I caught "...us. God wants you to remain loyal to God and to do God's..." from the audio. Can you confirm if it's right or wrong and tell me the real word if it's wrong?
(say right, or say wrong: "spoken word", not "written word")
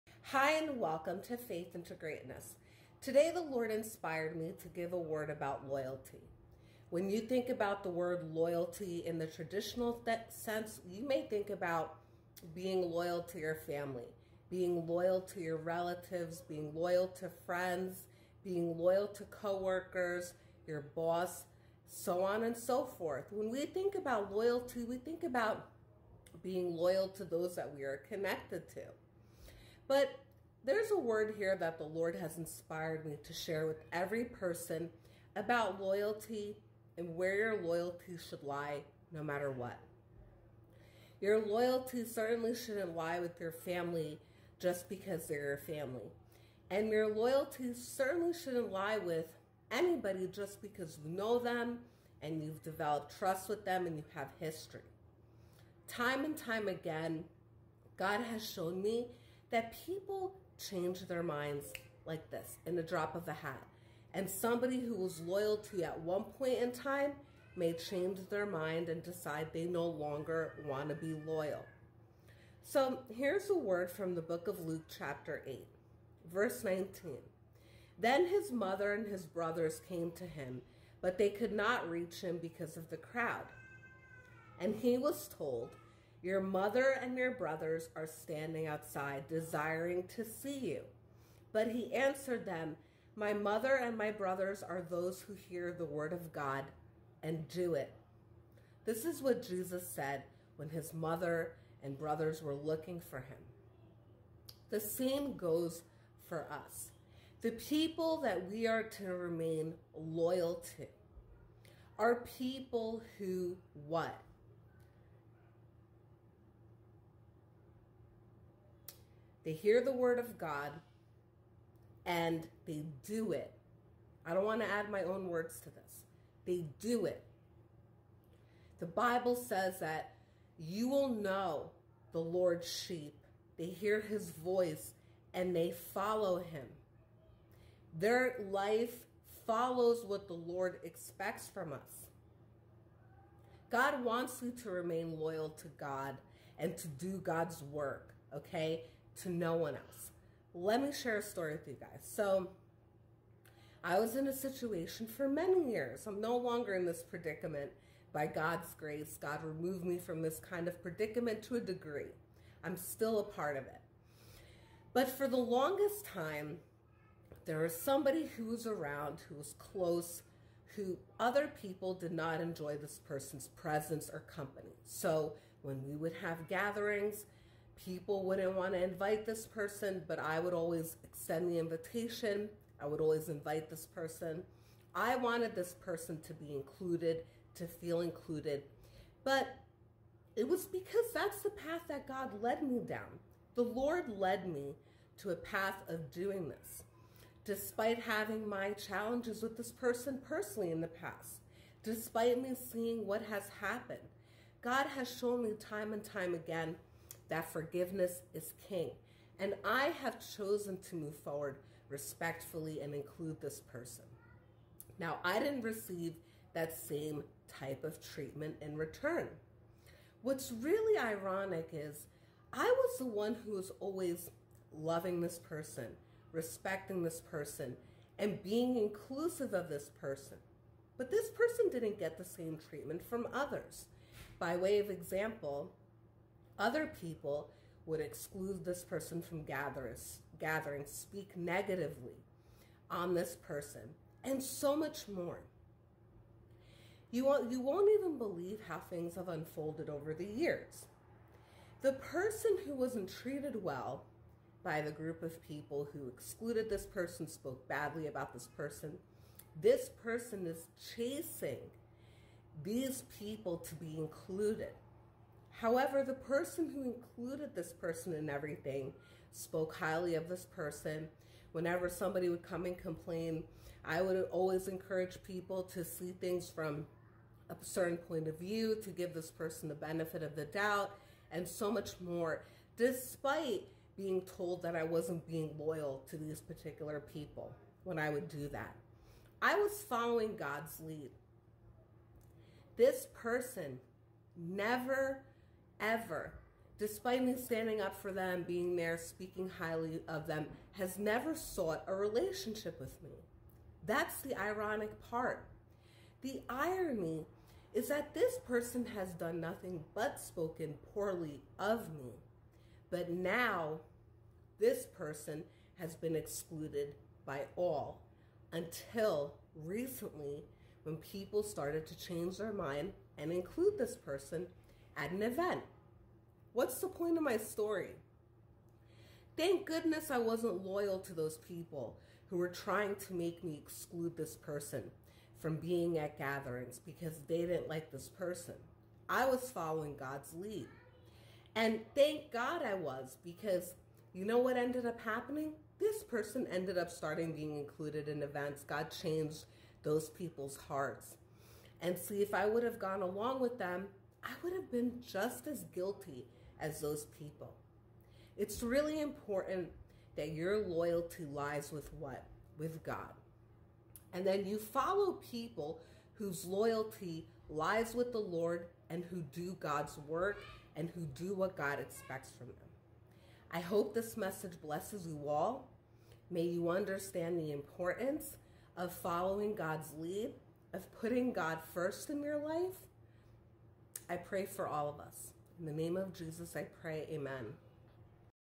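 right.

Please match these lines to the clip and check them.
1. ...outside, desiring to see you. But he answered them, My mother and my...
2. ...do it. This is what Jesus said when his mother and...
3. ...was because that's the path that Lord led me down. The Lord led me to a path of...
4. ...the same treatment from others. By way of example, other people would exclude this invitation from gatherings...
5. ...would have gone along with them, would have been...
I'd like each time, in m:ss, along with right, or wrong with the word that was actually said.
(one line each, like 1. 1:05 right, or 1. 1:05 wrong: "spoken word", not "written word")
1. 1:28 right
2. 1:37 right
3. 3:10 wrong: "God", not "Lord"
4. 3:52 wrong: "person", not "invitation"
5. 5:52 right.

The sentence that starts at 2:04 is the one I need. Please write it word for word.
I don't want to add my own words to this.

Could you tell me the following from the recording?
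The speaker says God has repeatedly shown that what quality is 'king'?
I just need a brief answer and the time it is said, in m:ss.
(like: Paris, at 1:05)
Forgiveness, at 3:27.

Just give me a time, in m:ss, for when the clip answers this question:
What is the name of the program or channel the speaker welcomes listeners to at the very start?
0:01.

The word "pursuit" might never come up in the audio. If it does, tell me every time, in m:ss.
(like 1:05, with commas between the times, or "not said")
not said.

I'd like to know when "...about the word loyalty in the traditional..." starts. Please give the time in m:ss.
0:07.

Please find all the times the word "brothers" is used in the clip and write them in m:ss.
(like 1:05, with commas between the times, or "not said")
1:19, 1:27, 1:34, 1:41.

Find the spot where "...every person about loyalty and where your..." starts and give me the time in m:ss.
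0:33.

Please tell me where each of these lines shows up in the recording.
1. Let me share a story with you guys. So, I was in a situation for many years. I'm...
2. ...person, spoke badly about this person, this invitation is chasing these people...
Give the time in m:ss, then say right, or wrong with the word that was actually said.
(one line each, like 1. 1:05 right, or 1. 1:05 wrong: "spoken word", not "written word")
1. 2:30 right
2. 4:16 wrong: "person", not "invitation".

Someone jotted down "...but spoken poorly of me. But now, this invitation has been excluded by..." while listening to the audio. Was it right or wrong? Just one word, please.
wrong.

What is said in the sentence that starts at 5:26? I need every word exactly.
What's the point of my story?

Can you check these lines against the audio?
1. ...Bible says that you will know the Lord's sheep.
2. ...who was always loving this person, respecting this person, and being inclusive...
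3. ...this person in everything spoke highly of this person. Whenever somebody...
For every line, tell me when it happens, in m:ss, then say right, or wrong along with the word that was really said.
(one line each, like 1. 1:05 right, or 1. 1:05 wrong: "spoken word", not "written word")
1. 2:08 right
2. 3:43 right
3. 4:27 right.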